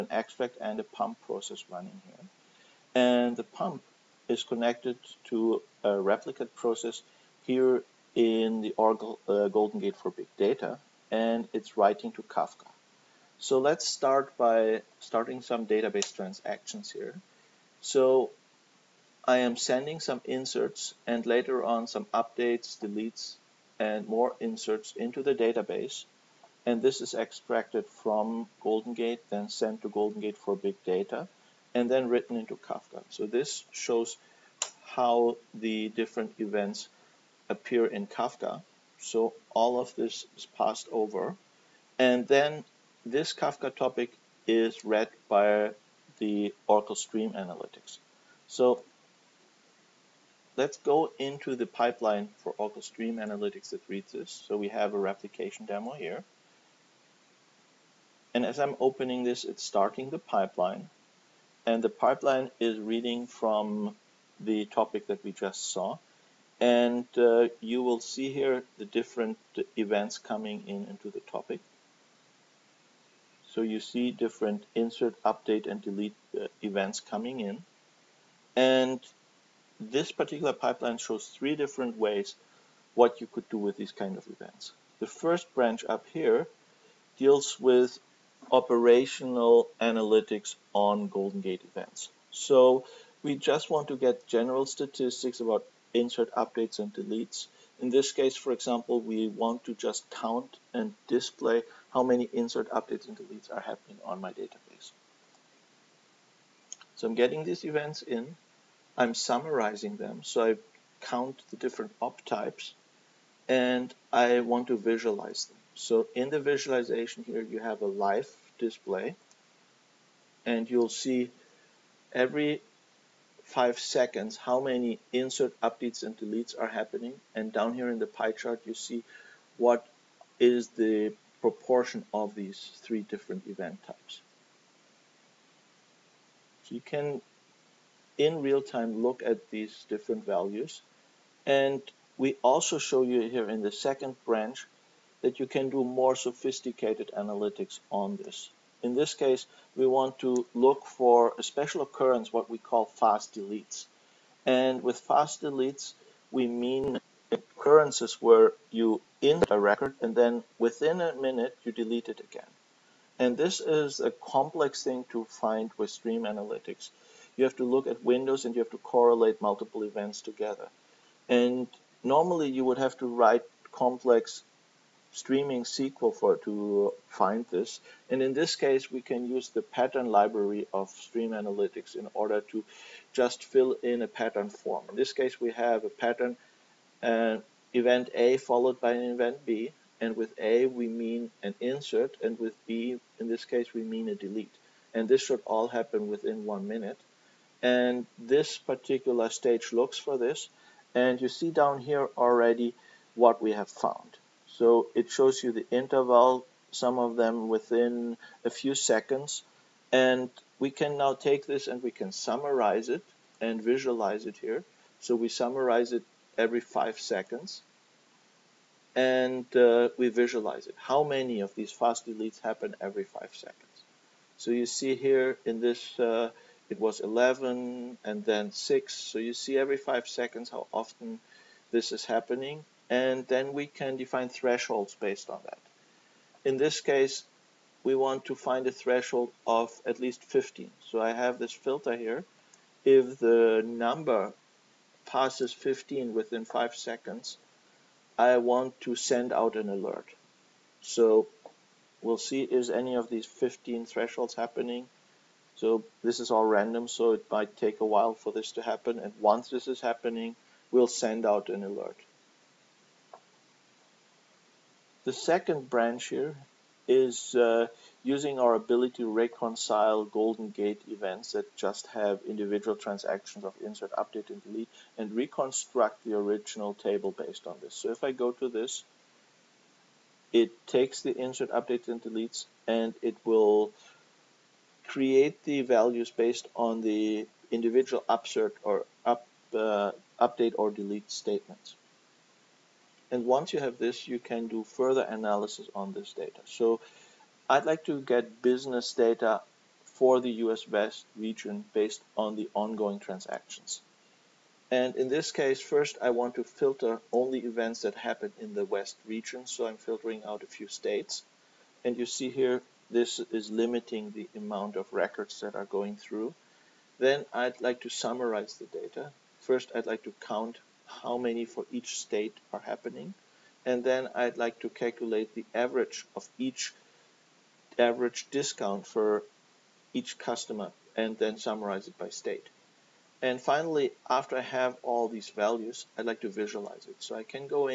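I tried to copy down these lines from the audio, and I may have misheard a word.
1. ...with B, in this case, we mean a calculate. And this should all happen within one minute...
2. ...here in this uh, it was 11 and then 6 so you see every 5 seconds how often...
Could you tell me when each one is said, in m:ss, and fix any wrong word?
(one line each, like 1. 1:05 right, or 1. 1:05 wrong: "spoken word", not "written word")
1. 3:12 wrong: "delete", not "calculate"
2. 3:44 right.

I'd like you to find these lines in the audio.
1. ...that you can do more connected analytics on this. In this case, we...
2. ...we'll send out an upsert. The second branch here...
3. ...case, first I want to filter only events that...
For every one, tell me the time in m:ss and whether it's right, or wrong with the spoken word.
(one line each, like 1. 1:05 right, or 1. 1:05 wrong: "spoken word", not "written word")
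1. 2:25 wrong: "sophisticated", not "connected"
2. 4:20 wrong: "alert", not "upsert"
3. 5:05 right.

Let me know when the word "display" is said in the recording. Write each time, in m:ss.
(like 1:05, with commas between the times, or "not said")
1:41, 1:58.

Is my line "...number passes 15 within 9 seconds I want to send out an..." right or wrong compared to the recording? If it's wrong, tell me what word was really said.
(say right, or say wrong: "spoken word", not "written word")
wrong: "5", not "9".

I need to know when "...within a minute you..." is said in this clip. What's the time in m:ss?
2:40.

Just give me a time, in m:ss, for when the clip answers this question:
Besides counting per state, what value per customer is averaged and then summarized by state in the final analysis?
5:27.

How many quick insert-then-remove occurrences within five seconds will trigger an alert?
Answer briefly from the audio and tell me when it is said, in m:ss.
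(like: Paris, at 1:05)
15, at 3:59.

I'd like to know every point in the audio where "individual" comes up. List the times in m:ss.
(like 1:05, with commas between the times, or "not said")
4:32, 4:47.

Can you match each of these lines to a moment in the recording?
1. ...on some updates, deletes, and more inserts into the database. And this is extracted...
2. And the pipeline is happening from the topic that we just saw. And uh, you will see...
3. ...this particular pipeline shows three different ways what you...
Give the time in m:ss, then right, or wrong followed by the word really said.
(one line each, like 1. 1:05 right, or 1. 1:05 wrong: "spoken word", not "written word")
1. 0:21 right
2. 1:01 wrong: "reading", not "happening"
3. 1:19 right.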